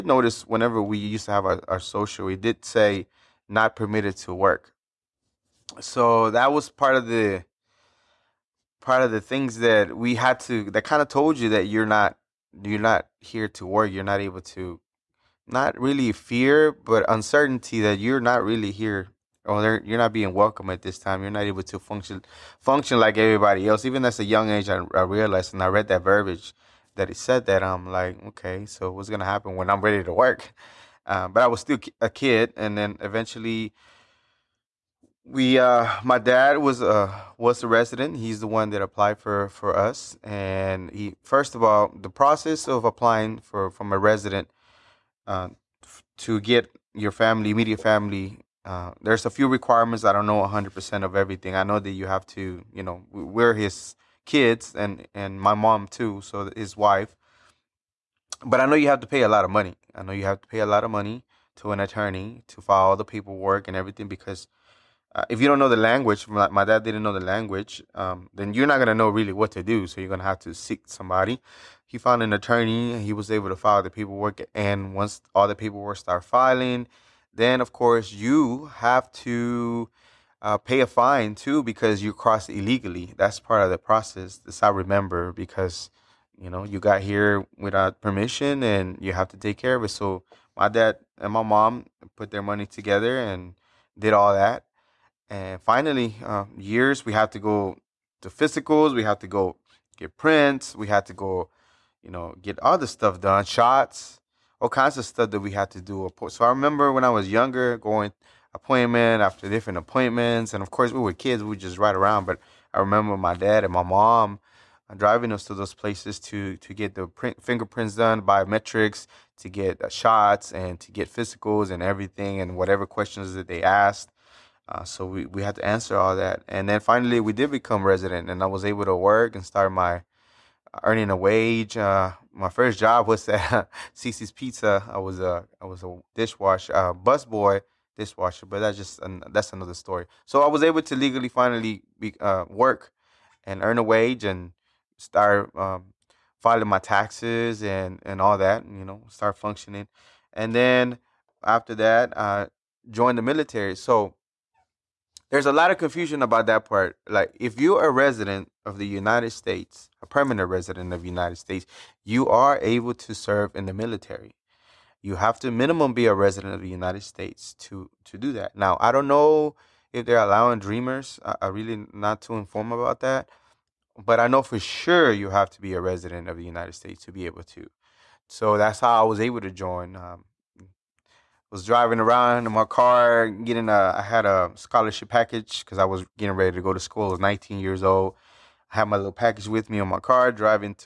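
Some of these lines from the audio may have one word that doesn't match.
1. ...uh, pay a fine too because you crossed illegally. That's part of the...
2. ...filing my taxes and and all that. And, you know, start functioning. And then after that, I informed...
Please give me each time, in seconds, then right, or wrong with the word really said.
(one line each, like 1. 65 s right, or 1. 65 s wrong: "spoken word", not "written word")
1. 80 s right
2. 146 s wrong: "joined", not "informed".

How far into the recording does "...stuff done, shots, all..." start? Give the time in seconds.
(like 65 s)
102 s.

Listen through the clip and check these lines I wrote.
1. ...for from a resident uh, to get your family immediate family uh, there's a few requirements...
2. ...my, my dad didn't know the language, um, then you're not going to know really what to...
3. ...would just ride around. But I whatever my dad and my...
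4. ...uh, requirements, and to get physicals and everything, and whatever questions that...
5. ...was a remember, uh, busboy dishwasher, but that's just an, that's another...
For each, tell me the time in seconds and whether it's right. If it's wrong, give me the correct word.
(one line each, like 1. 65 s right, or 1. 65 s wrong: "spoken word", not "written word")
1. 43 s right
2. 66 s right
3. 111 s wrong: "remember", not "whatever"
4. 119 s wrong: "shots", not "requirements"
5. 135 s wrong: "dishwasher", not "remember".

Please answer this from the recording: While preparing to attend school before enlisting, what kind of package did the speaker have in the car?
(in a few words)
Scholarship package.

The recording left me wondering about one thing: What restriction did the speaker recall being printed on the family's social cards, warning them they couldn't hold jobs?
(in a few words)
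Not permitted to work.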